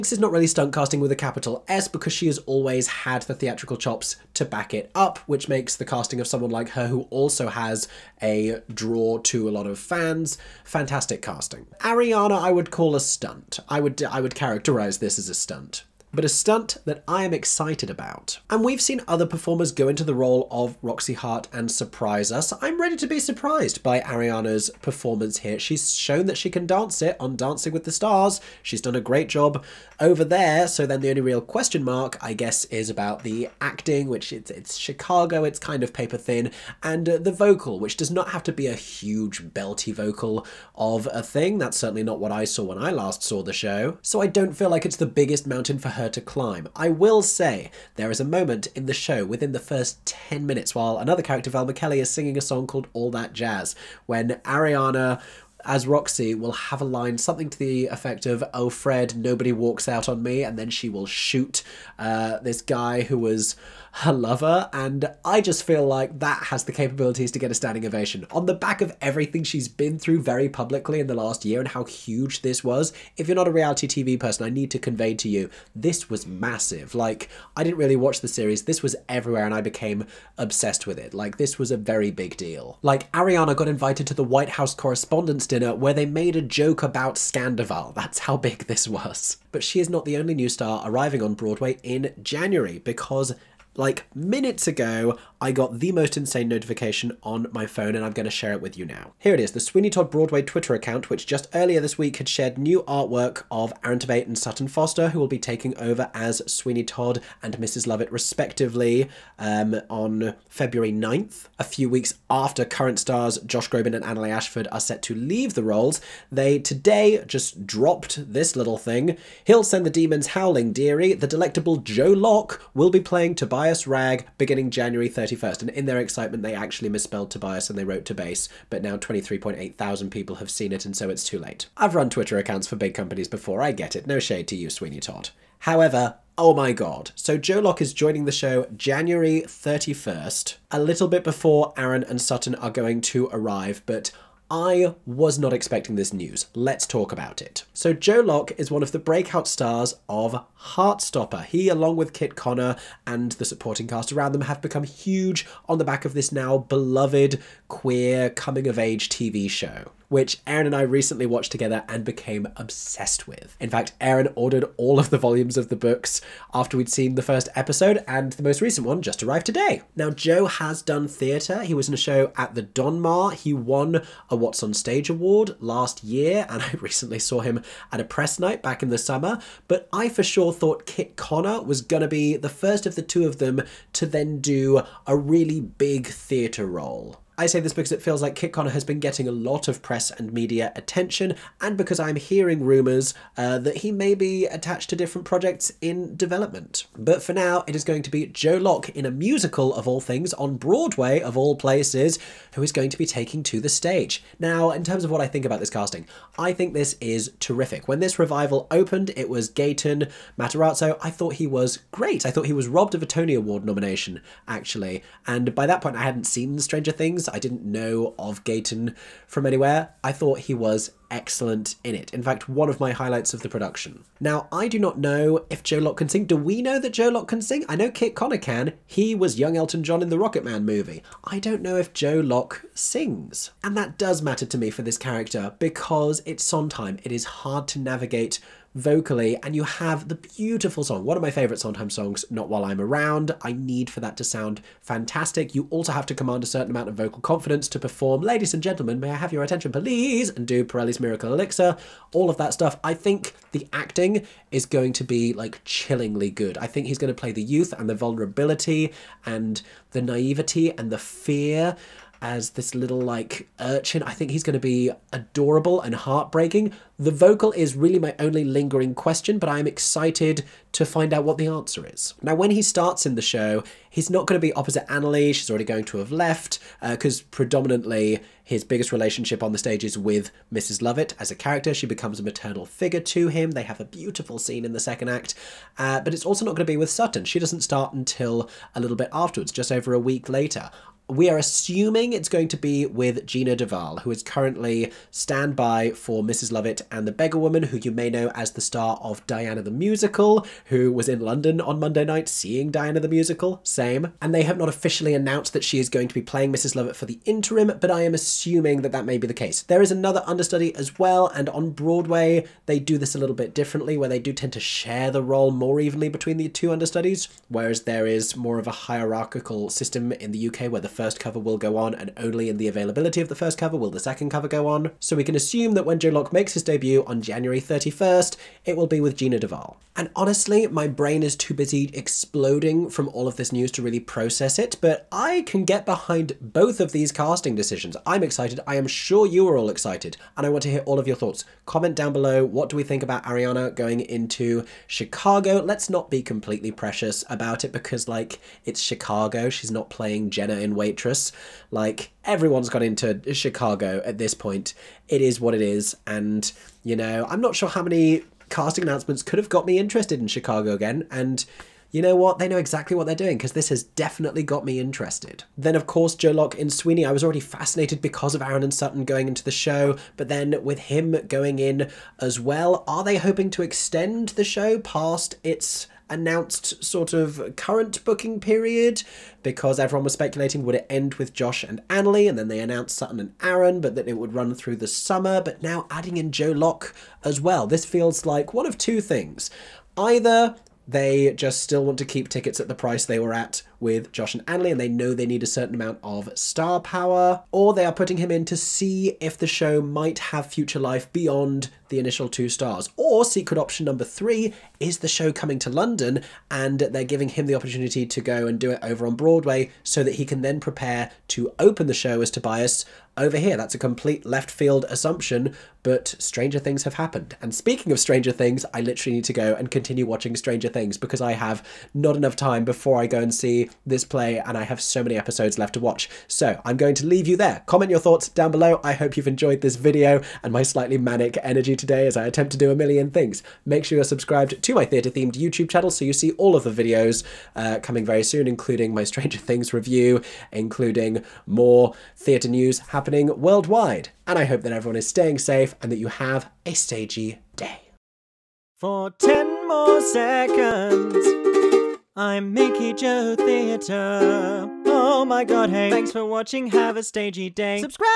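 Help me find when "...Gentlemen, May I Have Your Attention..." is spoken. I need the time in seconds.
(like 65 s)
248 s.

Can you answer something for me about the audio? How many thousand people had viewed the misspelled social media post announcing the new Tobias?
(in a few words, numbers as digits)
23.8 thousand.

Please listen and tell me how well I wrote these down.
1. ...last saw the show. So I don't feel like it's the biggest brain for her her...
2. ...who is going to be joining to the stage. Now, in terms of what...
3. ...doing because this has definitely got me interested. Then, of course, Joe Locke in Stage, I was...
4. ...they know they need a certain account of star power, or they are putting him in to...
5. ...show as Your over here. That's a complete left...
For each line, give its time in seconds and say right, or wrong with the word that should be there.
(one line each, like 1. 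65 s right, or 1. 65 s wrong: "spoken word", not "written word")
1. 42 s wrong: "mountain", not "brain"
2. 202 s wrong: "taking", not "joining"
3. 363 s wrong: "Sweeney", not "Stage"
4. 394 s wrong: "amount", not "account"
5. 411 s wrong: "Tobias", not "Your".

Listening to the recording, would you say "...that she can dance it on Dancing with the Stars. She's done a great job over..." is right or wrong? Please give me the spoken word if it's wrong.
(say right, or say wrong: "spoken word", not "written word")
right.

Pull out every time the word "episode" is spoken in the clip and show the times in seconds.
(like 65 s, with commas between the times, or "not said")
167 s, 425 s.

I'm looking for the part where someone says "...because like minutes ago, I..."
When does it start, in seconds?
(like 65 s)
92 s.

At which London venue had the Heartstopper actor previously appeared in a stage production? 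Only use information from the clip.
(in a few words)
the Donmar.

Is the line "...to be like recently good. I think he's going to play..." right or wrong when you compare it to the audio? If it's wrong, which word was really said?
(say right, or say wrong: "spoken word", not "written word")
wrong: "chillingly", not "recently".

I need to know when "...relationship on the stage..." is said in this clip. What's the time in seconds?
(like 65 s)
278 s.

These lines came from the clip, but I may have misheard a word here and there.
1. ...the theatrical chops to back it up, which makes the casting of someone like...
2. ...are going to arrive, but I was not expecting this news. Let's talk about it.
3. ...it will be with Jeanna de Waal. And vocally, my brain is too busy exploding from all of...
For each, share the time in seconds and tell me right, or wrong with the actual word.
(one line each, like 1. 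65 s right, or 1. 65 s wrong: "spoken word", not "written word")
1. 3 s right
2. 142 s right
3. 328 s wrong: "honestly", not "vocally".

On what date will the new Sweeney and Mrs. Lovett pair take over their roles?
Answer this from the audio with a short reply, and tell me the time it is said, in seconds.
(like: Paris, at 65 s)
February 9th, at 110 s.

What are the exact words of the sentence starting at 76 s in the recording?
Like, I didn't really watch the series, this was everywhere, and I became obsessed with it.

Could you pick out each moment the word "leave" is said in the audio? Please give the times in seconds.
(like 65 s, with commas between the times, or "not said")
115 s, 427 s.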